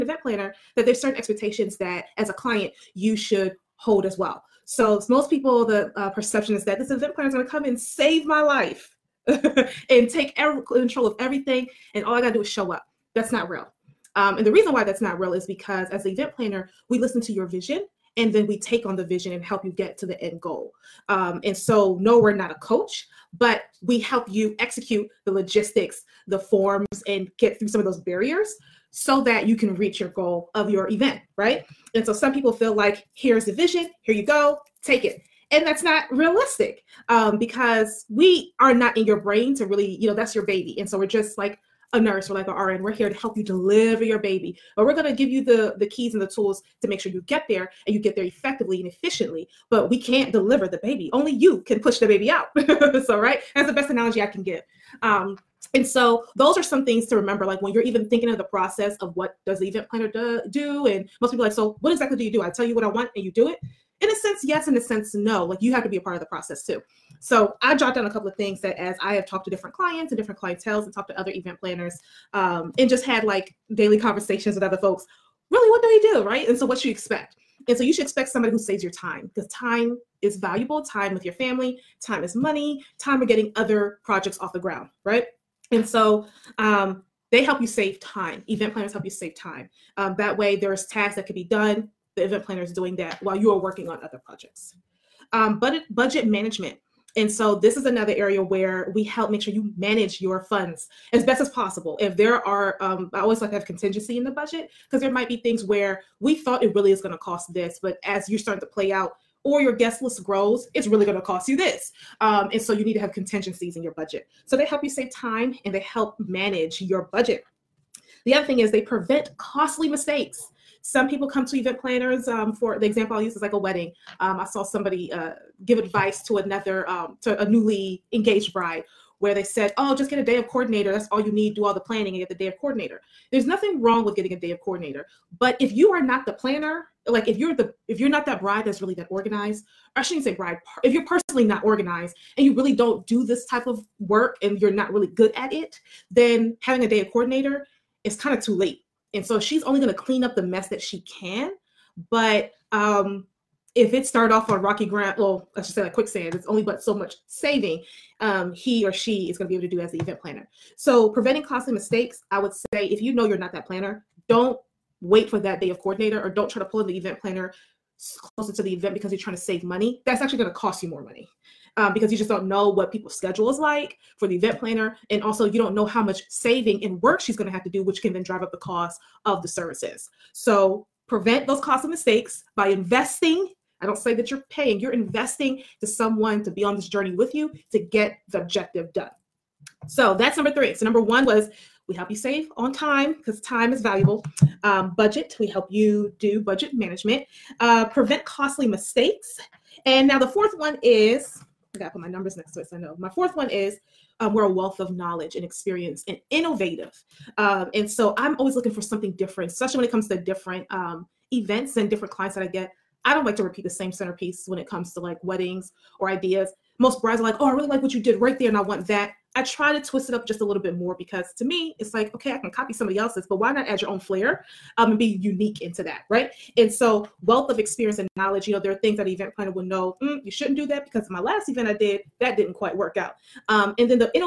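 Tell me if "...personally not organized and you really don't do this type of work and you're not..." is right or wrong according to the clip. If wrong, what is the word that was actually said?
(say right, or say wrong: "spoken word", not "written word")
right.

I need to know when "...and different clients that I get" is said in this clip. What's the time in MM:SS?
03:31.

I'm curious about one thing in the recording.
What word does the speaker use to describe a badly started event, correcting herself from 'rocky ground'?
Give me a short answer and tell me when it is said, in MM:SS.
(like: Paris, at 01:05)
Quicksand, at 02:35.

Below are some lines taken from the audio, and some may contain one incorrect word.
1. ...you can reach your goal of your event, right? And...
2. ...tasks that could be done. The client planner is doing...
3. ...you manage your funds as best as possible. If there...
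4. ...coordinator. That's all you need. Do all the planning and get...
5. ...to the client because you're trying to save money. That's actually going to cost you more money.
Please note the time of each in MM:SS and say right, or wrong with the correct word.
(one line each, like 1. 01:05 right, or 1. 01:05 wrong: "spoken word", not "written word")
1. 00:29 right
2. 01:30 wrong: "event", not "client"
3. 01:39 right
4. 02:10 right
5. 02:48 wrong: "event", not "client".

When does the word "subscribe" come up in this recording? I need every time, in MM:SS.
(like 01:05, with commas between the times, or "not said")
not said.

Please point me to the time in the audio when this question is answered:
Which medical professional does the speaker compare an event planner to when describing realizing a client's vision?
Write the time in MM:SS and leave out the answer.
00:42.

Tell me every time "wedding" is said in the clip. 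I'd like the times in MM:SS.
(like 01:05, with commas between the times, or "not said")
02:03, 03:35.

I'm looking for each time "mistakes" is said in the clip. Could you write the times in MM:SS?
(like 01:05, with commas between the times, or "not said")
01:59, 02:41, 03:01, 03:18.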